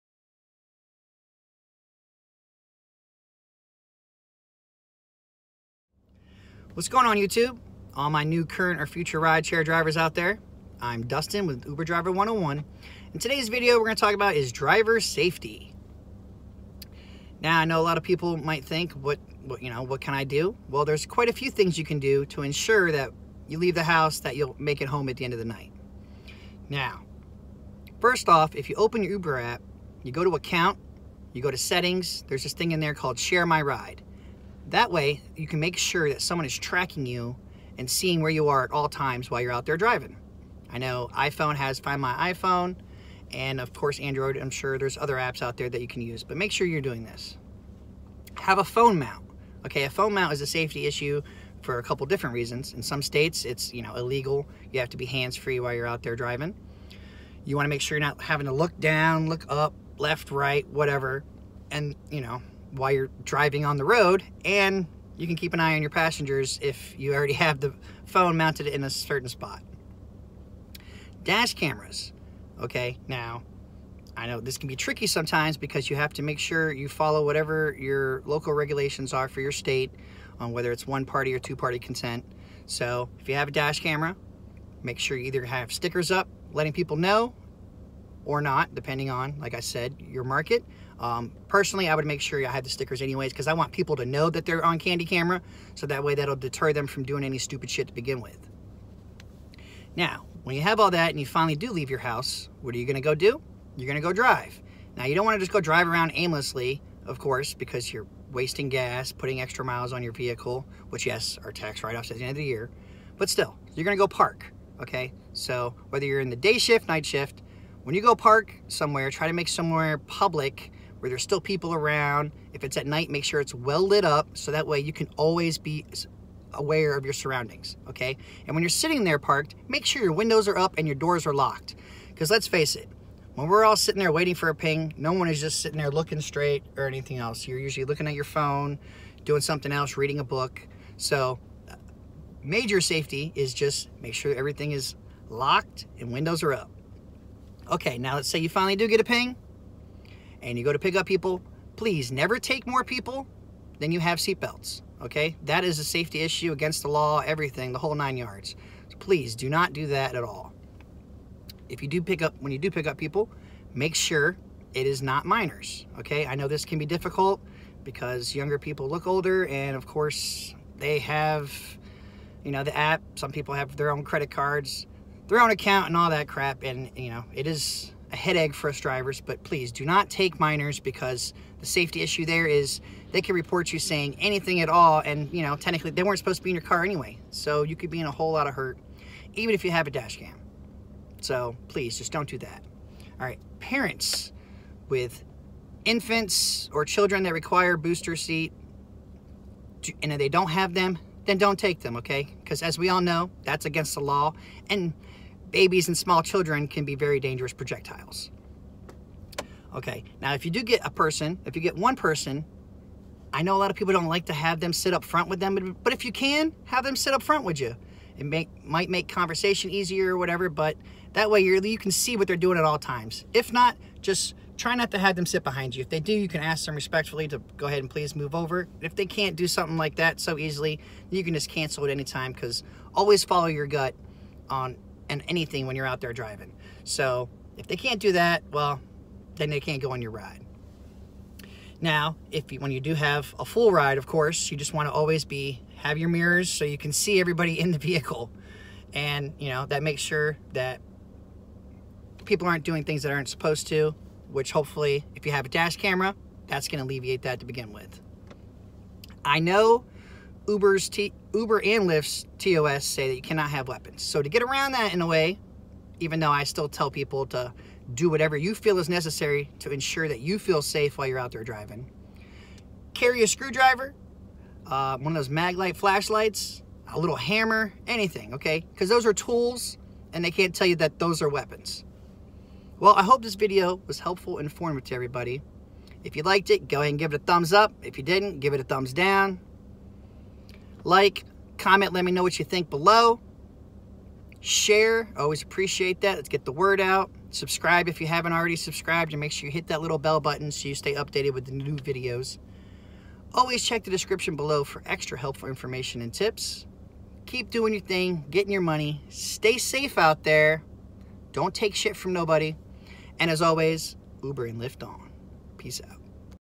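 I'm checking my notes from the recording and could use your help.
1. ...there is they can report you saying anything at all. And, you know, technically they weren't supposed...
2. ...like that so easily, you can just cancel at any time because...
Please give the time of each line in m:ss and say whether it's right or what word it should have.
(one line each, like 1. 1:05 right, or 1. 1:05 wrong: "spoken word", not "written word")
1. 3:02 right
2. 3:49 right.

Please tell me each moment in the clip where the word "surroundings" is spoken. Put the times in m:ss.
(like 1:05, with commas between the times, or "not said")
2:07.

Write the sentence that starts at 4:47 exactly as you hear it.
If you didn't, give it a thumbs down.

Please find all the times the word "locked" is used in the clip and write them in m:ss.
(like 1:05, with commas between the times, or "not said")
2:11, 2:25.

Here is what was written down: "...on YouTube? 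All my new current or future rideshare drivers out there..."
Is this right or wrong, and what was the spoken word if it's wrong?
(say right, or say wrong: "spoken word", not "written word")
right.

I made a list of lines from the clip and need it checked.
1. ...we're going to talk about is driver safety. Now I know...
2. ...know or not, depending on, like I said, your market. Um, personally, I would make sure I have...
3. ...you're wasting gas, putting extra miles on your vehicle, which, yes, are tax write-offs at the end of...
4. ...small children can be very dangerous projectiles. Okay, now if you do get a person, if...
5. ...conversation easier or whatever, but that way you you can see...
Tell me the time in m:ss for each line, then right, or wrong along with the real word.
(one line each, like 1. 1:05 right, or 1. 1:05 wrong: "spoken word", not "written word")
1. 0:13 right
2. 1:26 right
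3. 1:47 right
4. 3:25 right
5. 3:39 right.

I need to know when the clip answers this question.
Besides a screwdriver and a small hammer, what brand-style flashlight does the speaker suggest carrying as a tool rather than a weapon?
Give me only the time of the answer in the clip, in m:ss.
4:35.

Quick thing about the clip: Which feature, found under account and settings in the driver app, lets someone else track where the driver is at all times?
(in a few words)
Share my ride.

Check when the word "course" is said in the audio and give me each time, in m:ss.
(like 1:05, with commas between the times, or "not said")
0:43, 1:47, 2:49, 4:04.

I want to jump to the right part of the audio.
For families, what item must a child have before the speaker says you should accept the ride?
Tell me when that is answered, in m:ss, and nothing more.
3:17.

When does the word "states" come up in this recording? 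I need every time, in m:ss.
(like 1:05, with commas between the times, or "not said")
0:53, 1:19.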